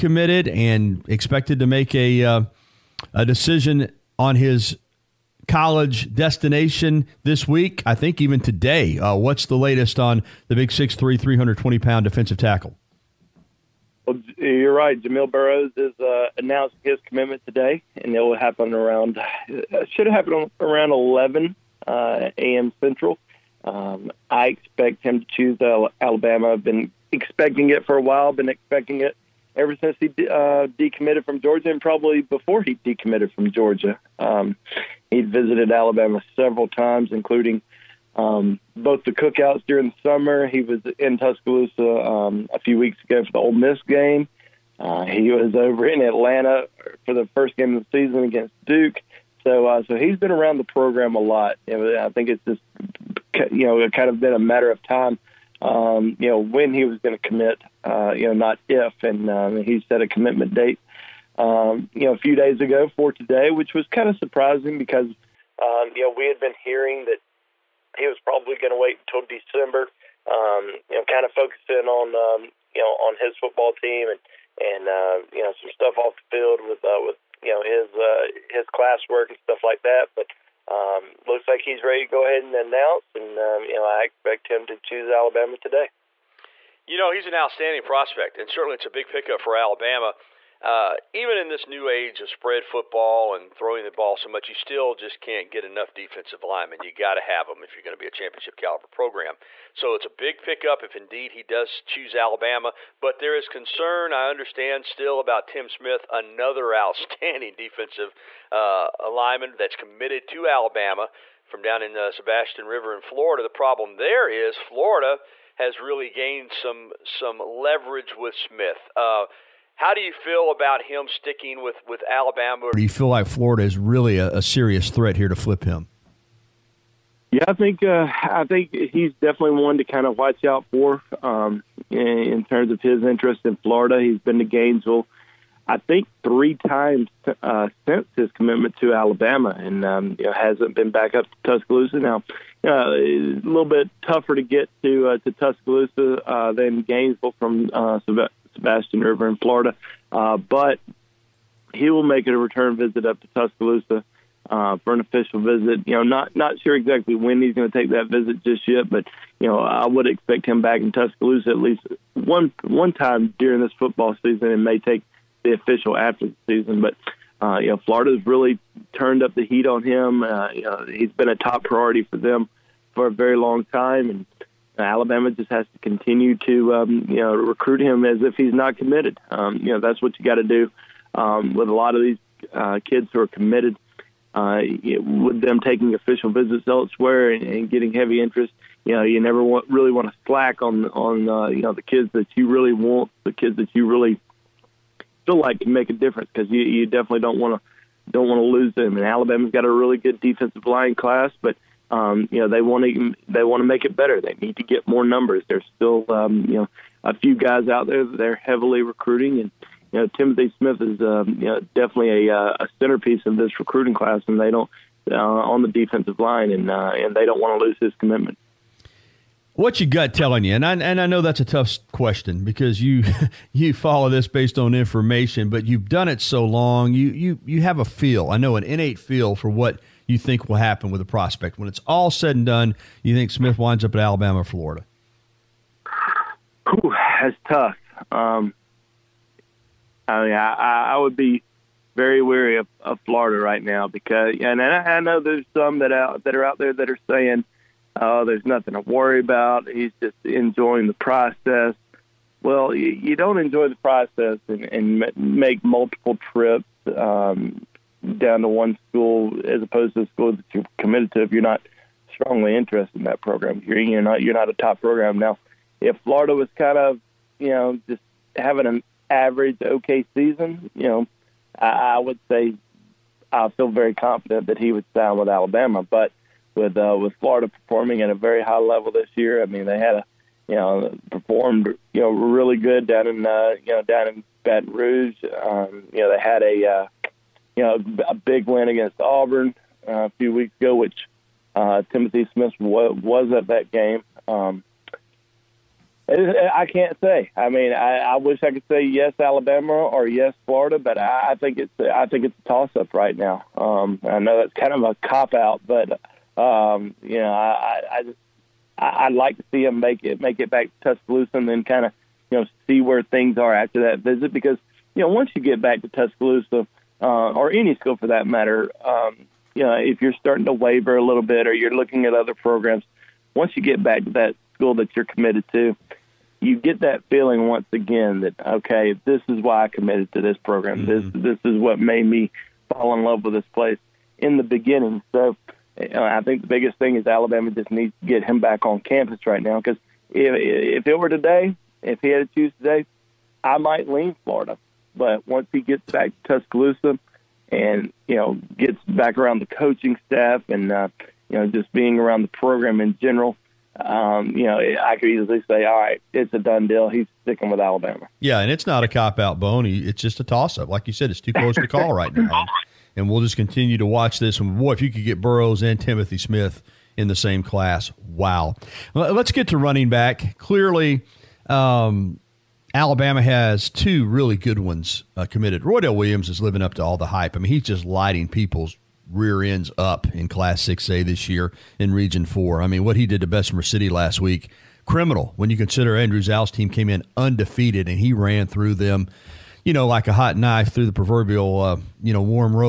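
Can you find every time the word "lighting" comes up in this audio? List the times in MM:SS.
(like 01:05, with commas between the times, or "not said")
06:17.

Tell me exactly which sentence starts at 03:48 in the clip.
I know an innate feel for what you think will happen with a prospect.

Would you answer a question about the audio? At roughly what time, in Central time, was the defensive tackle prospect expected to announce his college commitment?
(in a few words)
11 a.m. Central.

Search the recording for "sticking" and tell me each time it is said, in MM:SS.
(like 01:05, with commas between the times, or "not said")
02:01, 05:57.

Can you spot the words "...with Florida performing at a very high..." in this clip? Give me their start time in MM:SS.
04:36.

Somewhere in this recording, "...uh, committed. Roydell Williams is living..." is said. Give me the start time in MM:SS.
06:15.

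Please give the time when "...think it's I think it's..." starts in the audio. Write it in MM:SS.
05:01.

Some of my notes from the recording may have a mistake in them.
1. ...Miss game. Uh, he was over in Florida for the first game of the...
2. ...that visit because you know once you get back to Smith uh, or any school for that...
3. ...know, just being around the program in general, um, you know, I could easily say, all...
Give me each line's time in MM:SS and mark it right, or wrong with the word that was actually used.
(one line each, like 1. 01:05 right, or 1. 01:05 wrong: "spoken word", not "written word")
1. 00:43 wrong: "Atlanta", not "Florida"
2. 05:13 wrong: "Tuscaloosa", not "Smith"
3. 05:51 right.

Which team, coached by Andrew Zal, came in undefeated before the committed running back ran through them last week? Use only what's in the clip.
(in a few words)
Bessemer City.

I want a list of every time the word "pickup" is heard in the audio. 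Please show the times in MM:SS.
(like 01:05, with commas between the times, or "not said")
01:29, 01:40.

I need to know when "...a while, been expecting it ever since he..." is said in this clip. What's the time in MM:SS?
00:27.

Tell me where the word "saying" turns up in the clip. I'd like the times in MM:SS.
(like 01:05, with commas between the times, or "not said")
04:07.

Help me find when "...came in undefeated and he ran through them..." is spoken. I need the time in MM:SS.
06:26.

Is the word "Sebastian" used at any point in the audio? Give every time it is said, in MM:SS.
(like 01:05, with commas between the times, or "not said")
01:52, 02:28.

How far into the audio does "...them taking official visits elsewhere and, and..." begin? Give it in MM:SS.
03:05.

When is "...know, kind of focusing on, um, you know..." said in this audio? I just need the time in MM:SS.
01:10.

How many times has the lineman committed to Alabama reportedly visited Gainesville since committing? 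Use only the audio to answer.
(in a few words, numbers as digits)
3.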